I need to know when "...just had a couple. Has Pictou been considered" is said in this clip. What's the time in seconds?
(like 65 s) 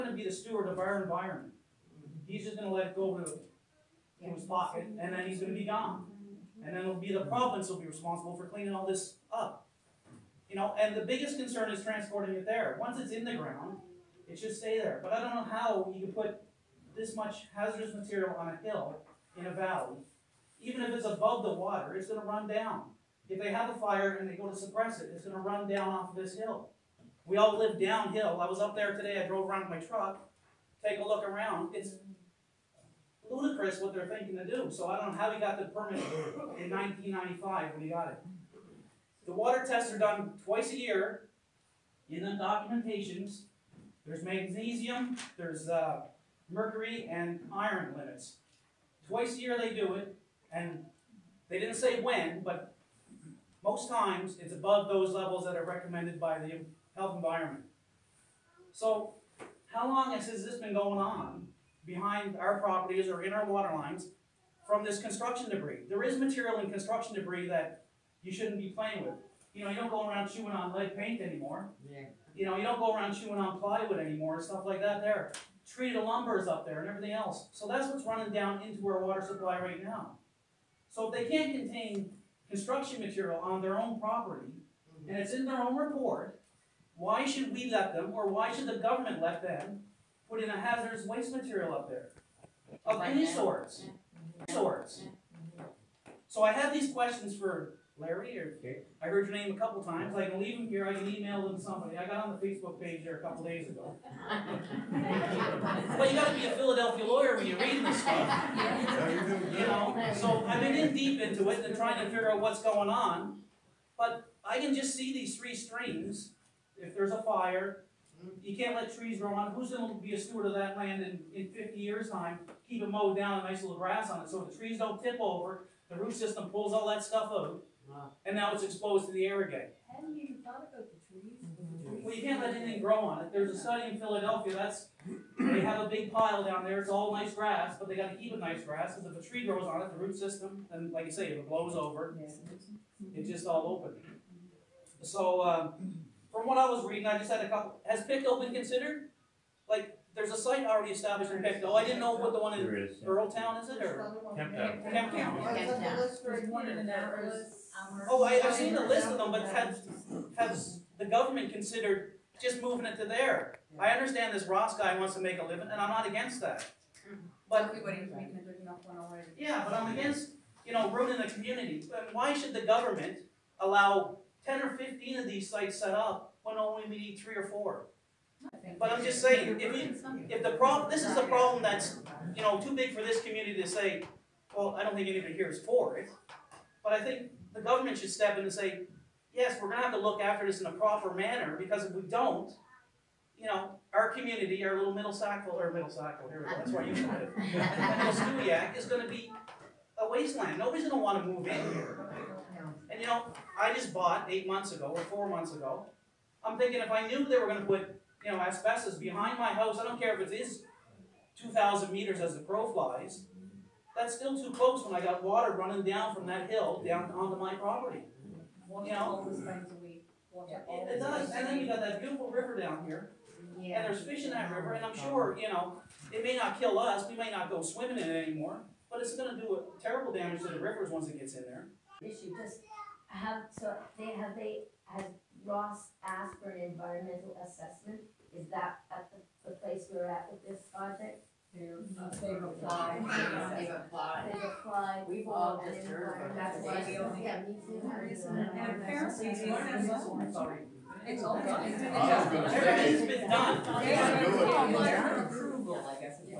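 147 s.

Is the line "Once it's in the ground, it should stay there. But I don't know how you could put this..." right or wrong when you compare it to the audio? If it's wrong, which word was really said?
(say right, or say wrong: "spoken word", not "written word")
right.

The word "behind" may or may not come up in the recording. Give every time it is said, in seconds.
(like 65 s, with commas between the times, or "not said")
61 s, 208 s.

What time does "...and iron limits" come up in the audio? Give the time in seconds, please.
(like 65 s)
47 s.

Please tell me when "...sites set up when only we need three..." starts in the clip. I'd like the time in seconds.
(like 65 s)
175 s.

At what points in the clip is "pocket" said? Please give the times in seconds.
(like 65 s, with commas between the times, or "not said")
4 s.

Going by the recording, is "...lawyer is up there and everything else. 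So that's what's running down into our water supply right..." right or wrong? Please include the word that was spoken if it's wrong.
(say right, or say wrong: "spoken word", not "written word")
wrong: "lumber", not "lawyer".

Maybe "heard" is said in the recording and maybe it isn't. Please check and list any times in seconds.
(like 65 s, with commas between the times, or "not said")
99 s.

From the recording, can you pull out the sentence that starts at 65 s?
There is material in construction debris that you shouldn't be playing with.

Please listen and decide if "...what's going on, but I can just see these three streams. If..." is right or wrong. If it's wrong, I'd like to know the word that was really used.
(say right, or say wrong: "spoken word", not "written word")
right.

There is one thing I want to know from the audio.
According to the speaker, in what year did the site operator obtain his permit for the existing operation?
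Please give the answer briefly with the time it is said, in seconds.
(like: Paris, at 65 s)
1995, at 36 s.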